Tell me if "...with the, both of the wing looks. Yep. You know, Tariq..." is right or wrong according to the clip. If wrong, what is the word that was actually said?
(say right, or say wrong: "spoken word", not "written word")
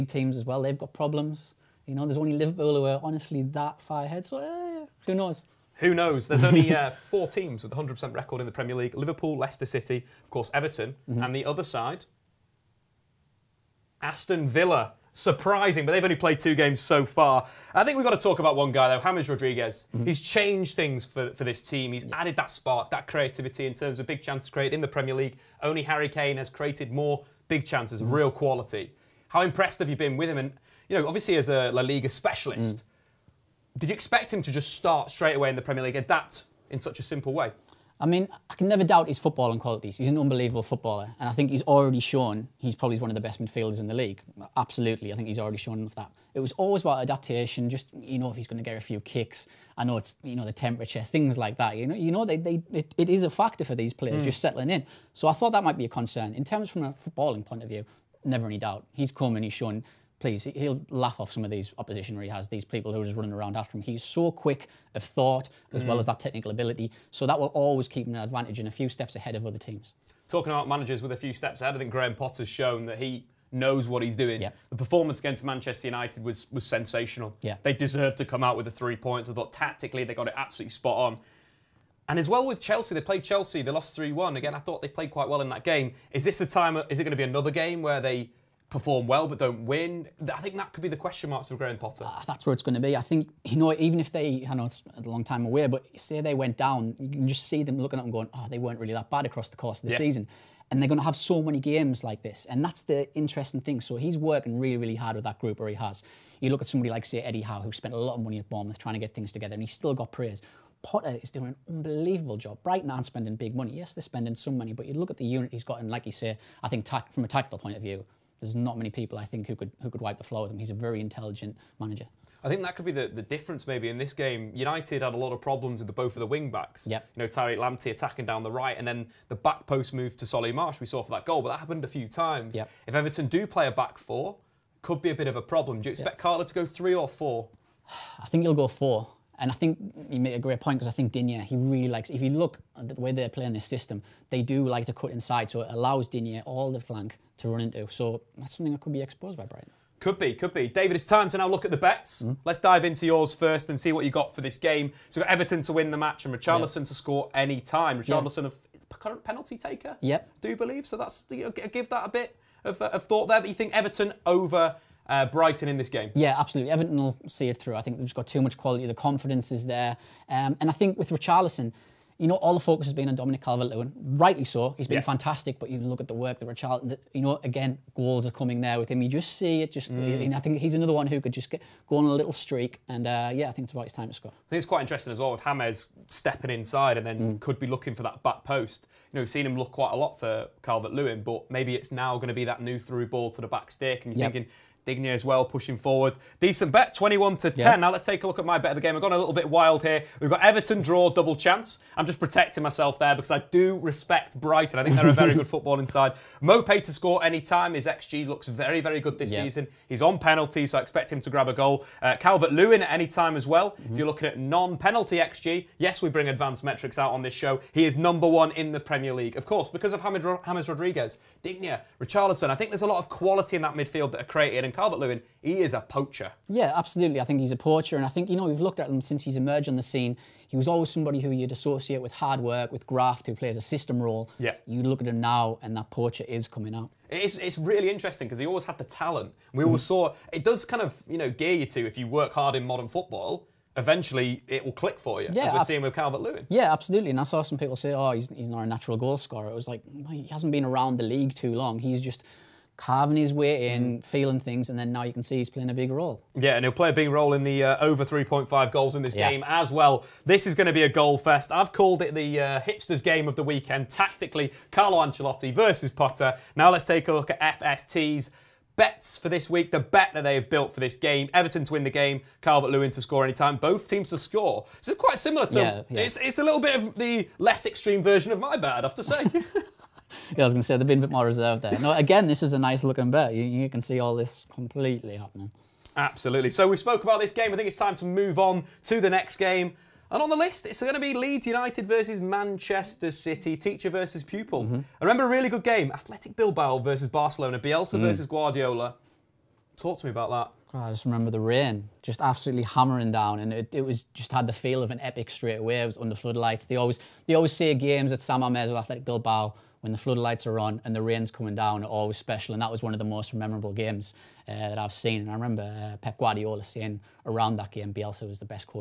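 wrong: "backs", not "looks".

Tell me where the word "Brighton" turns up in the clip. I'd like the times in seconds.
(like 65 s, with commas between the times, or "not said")
112 s, 149 s, 165 s, 204 s.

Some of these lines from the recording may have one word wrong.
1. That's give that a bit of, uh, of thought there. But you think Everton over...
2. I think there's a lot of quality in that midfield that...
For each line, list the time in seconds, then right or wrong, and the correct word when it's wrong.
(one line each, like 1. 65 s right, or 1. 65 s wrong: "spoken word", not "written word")
1. 160 s right
2. 222 s right.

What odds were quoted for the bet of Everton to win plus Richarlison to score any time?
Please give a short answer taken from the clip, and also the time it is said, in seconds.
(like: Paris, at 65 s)
21/10, at 196 s.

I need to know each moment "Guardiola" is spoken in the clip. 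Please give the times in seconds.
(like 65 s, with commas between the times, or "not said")
298 s, 316 s.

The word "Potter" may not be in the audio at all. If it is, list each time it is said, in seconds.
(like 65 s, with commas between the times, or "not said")
72 s, 91 s, 110 s, 265 s.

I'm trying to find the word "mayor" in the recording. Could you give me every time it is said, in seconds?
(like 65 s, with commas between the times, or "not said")
not said.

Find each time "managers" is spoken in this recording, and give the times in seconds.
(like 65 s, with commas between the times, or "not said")
70 s, 121 s.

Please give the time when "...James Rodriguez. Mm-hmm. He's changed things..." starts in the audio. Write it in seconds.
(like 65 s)
19 s.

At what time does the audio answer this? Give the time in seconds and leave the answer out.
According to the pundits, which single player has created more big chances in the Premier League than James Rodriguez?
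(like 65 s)
25 s.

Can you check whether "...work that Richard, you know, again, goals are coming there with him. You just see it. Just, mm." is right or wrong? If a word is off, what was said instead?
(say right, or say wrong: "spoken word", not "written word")
right.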